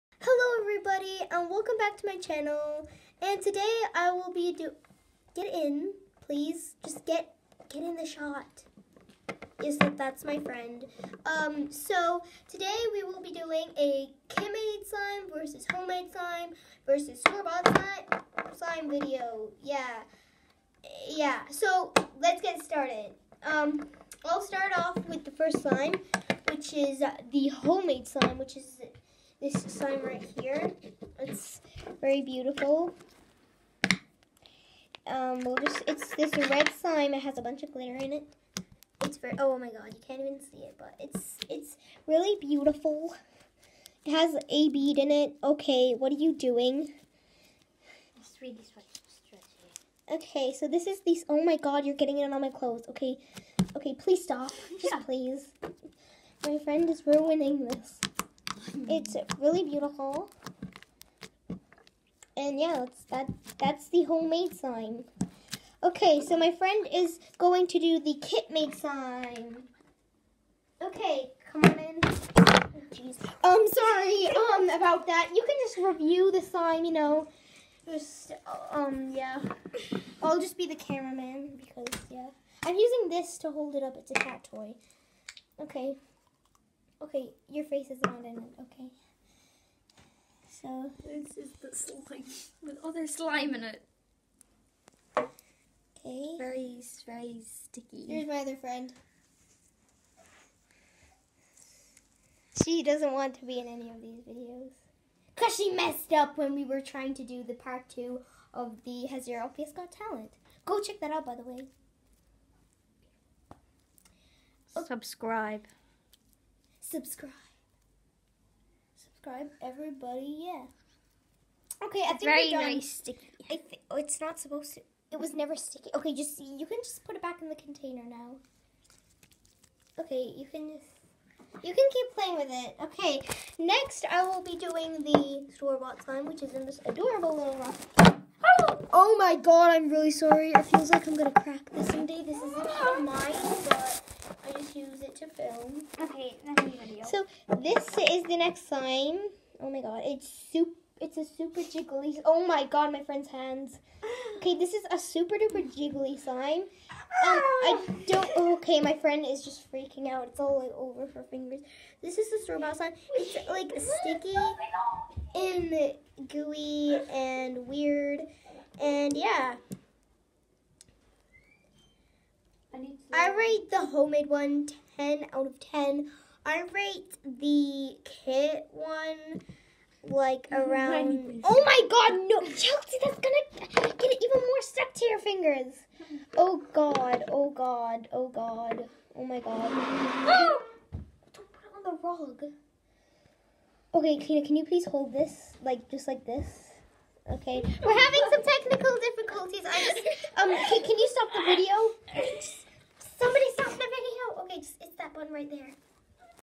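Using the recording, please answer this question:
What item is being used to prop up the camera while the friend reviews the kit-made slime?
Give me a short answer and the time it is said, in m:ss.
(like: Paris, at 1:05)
A cat toy, at 1:24.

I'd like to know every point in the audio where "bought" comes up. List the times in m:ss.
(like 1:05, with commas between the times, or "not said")
0:17, 2:15, 2:42.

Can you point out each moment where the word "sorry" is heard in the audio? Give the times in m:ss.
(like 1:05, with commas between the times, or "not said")
1:13, 2:20.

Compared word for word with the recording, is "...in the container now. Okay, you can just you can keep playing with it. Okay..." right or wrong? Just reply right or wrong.
right.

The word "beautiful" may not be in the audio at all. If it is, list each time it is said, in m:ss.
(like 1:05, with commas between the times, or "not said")
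0:32, 0:42, 0:59.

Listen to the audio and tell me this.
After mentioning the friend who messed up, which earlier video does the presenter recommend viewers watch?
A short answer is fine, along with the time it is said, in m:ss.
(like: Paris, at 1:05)
Has Your LPS Got Talent, at 1:49.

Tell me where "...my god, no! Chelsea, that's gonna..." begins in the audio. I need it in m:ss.
3:01.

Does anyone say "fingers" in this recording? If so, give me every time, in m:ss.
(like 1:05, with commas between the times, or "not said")
2:41, 3:05.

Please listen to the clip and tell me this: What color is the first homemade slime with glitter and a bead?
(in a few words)
Red.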